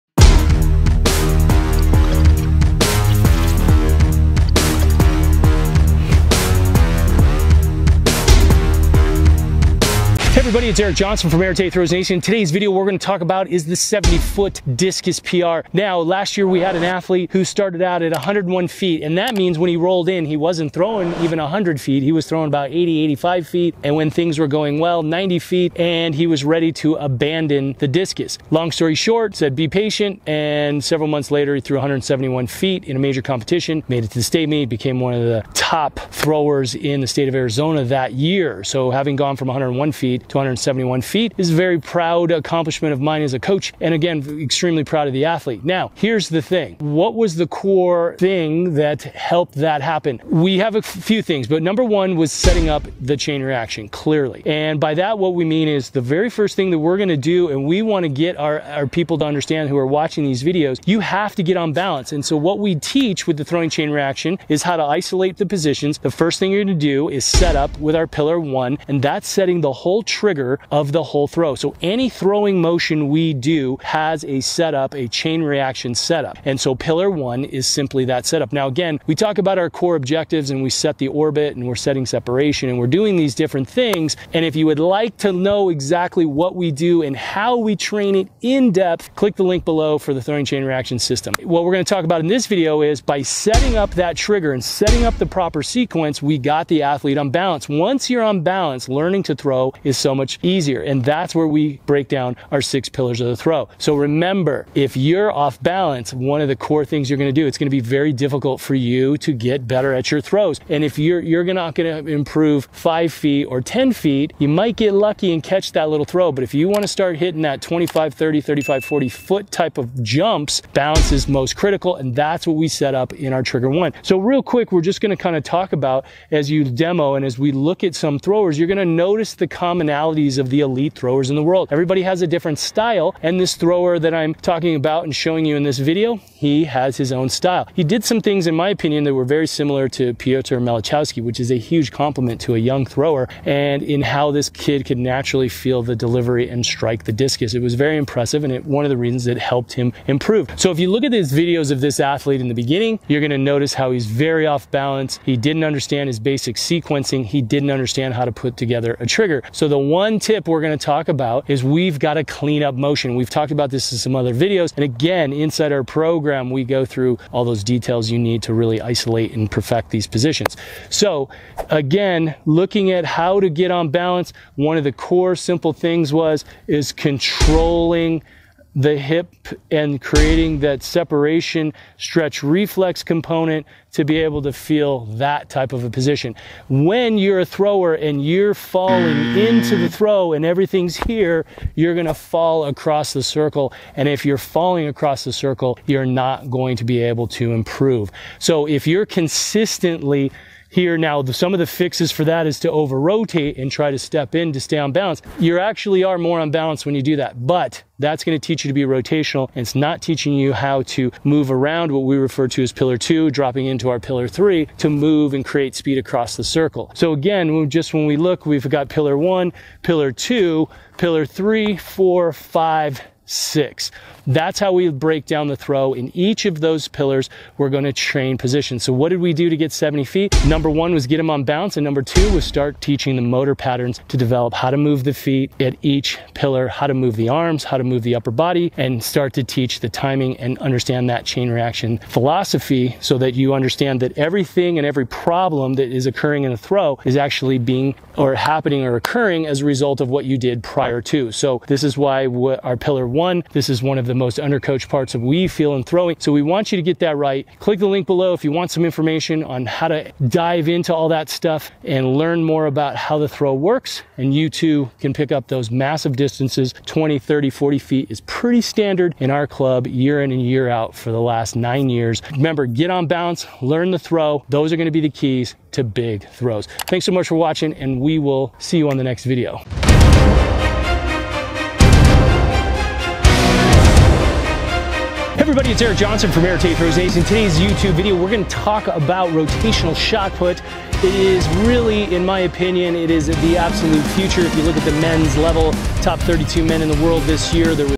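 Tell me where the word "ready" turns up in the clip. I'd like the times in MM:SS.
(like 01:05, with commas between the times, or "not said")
00:26.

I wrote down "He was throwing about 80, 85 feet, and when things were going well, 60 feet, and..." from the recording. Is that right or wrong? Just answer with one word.
wrong.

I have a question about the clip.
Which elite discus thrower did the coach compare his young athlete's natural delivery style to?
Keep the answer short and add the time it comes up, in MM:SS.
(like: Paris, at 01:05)
Piotr Malachowski, at 02:20.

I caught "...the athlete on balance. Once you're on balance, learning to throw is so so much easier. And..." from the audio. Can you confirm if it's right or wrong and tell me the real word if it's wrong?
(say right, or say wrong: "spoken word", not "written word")
right.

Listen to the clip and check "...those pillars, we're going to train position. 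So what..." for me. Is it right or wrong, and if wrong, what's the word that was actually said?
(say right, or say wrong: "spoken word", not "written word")
right.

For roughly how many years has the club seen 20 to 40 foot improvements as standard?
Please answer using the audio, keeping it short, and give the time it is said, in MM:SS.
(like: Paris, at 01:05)
9 years, at 04:31.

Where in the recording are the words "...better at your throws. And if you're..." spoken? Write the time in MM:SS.
01:49.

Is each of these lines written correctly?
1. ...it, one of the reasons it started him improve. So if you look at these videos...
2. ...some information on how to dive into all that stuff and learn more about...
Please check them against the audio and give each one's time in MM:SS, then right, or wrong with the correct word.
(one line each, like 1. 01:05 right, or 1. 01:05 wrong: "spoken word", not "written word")
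1. 02:28 wrong: "helped", not "started"
2. 04:18 right.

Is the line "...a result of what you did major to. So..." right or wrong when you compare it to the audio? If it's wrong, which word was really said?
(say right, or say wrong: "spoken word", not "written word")
wrong: "prior", not "major".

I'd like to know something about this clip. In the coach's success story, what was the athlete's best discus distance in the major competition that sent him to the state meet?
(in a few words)
171 feet.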